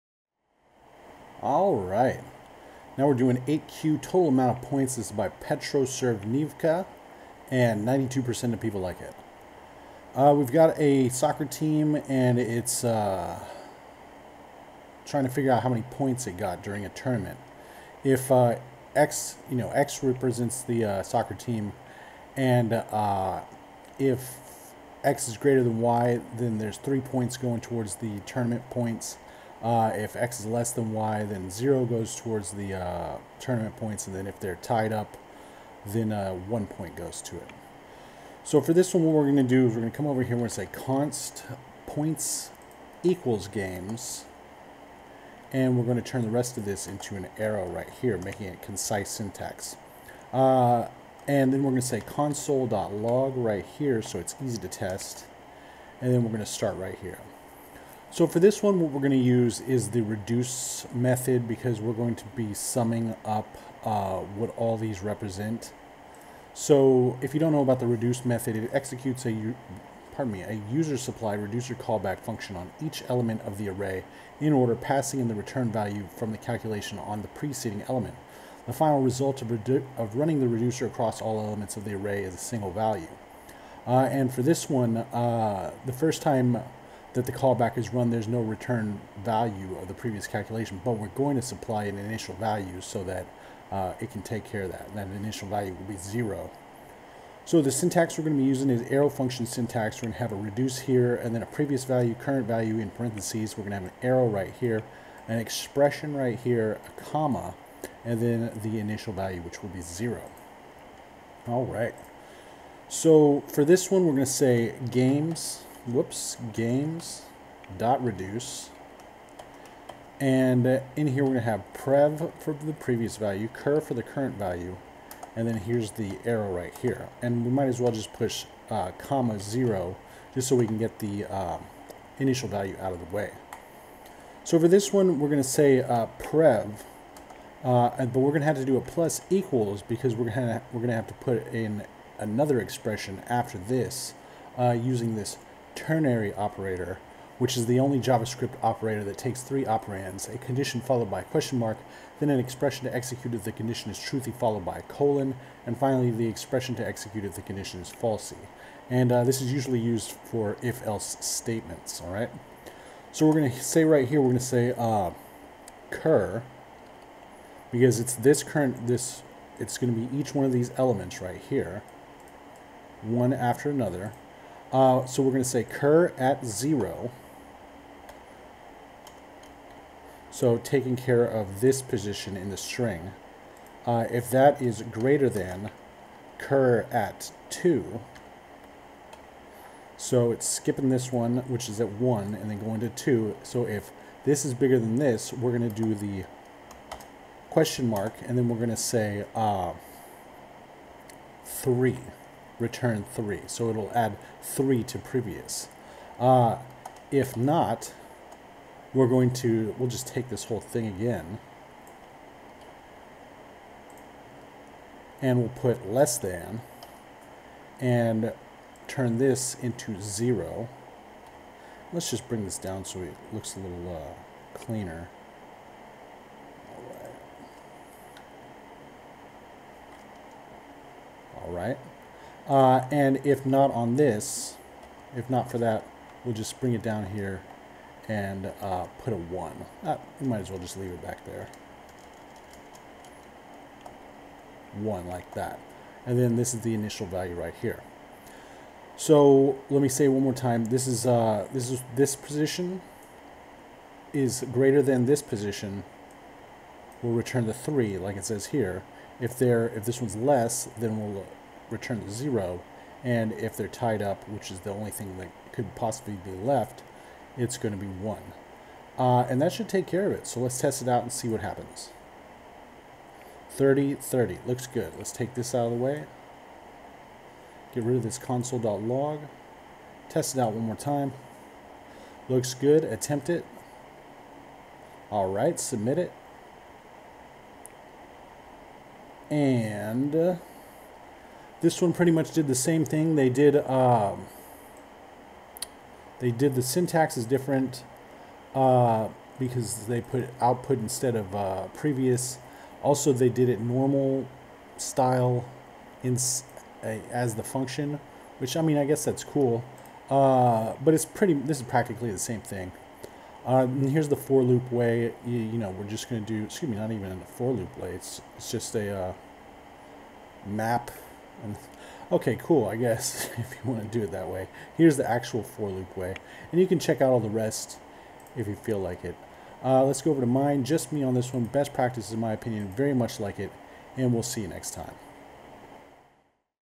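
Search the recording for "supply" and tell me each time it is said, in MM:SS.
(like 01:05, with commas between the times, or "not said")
01:10, 01:31.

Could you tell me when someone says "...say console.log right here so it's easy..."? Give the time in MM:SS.
00:51.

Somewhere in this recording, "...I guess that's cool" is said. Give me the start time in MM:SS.
05:08.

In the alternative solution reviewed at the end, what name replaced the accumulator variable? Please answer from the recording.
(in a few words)
output.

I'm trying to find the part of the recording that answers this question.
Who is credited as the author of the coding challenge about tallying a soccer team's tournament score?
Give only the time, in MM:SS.
00:05.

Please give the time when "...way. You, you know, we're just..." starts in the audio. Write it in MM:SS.
05:14.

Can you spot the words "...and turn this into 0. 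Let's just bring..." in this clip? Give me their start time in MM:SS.
03:37.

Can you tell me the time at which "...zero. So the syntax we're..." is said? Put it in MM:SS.
01:35.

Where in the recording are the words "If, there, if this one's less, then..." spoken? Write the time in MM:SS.
04:19.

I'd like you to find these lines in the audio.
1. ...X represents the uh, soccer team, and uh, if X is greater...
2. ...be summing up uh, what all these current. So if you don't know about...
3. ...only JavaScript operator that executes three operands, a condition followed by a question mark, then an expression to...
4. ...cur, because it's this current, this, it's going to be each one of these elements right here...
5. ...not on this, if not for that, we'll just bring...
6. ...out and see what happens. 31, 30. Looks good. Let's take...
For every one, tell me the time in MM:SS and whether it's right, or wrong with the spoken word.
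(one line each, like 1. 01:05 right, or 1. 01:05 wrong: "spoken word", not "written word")
1. 00:19 right
2. 01:02 wrong: "represent", not "current"
3. 02:27 wrong: "takes", not "executes"
4. 02:45 right
5. 03:53 right
6. 04:30 wrong: "30", not "31".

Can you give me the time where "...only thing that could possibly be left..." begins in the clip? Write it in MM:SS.
04:24.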